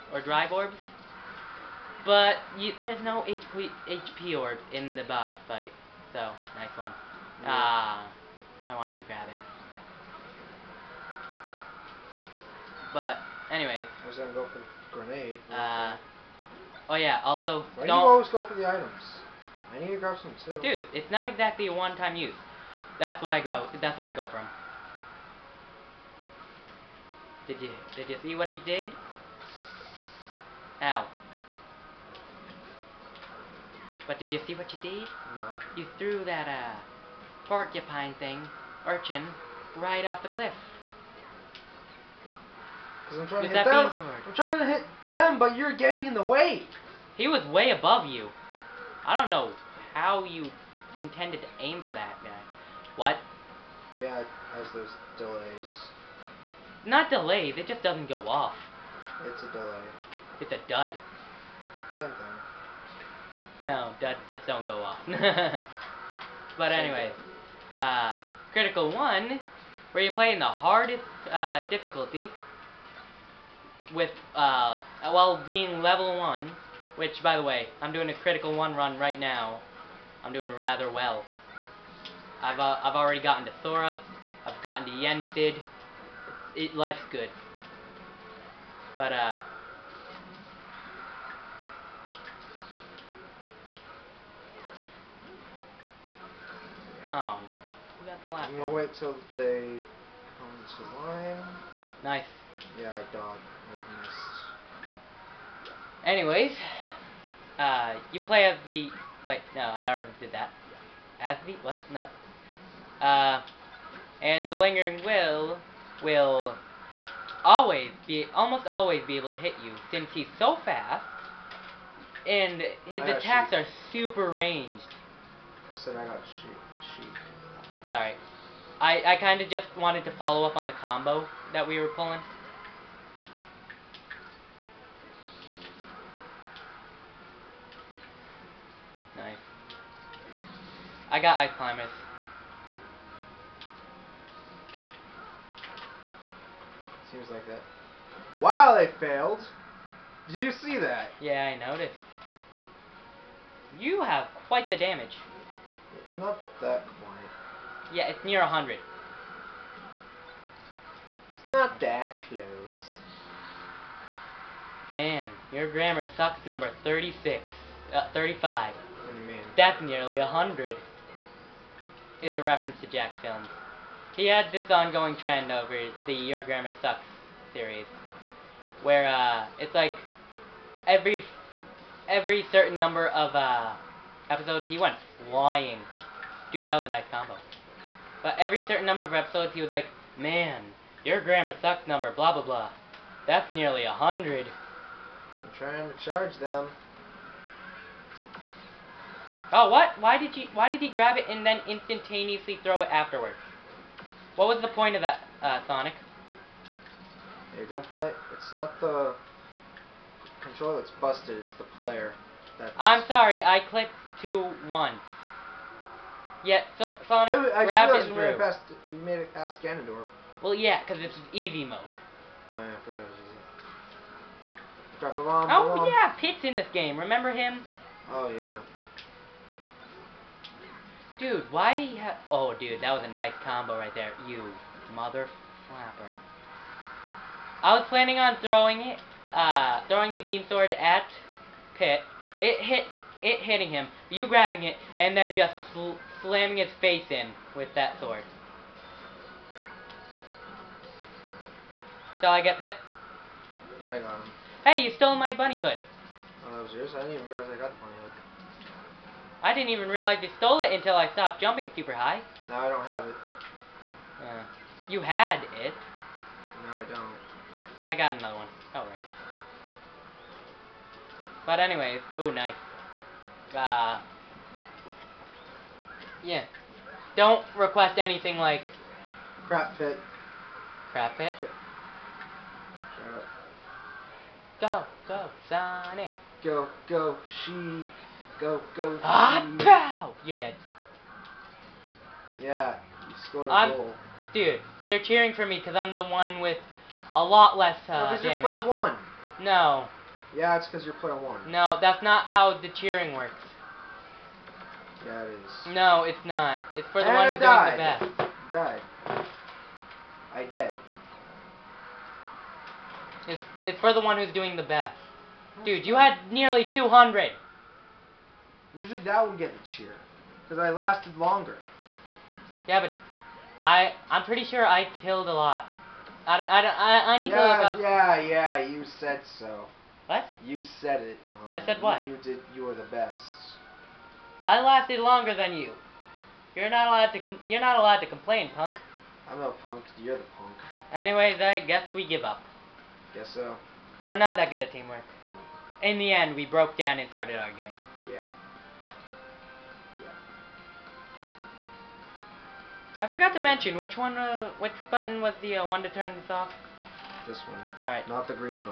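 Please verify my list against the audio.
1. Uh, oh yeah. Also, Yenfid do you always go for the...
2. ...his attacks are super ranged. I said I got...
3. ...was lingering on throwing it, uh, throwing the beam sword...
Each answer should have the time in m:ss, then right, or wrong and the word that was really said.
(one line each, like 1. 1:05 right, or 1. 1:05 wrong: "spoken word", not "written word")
1. 0:15 wrong: "Why", not "Yenfid"
2. 2:02 right
3. 3:57 wrong: "planning", not "lingering".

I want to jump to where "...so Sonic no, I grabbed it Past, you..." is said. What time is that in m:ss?
3:36.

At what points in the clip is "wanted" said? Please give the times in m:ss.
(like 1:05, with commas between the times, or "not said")
0:08, 2:09.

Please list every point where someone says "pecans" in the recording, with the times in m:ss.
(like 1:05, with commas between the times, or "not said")
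not said.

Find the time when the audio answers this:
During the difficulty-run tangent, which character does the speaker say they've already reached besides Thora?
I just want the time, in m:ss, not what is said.
1:24.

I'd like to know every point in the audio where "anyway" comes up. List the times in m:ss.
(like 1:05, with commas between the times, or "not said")
0:13, 1:06, 1:46, 4:31, 5:40.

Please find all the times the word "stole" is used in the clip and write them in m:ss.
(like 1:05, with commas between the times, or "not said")
4:14, 4:20.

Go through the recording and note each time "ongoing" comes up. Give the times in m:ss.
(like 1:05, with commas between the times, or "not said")
2:54.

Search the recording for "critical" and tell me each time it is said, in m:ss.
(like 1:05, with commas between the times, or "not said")
1:08, 1:18.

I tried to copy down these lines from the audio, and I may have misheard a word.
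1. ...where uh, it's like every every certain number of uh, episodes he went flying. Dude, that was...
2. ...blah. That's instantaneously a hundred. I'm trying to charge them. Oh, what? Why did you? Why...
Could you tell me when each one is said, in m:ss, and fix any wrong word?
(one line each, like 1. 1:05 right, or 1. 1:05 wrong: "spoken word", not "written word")
1. 2:58 right
2. 3:12 wrong: "nearly", not "instantaneously".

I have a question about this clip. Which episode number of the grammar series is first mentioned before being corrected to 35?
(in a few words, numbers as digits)
36.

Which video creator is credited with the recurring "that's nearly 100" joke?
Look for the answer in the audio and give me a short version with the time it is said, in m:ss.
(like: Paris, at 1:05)
Jack films, at 2:52.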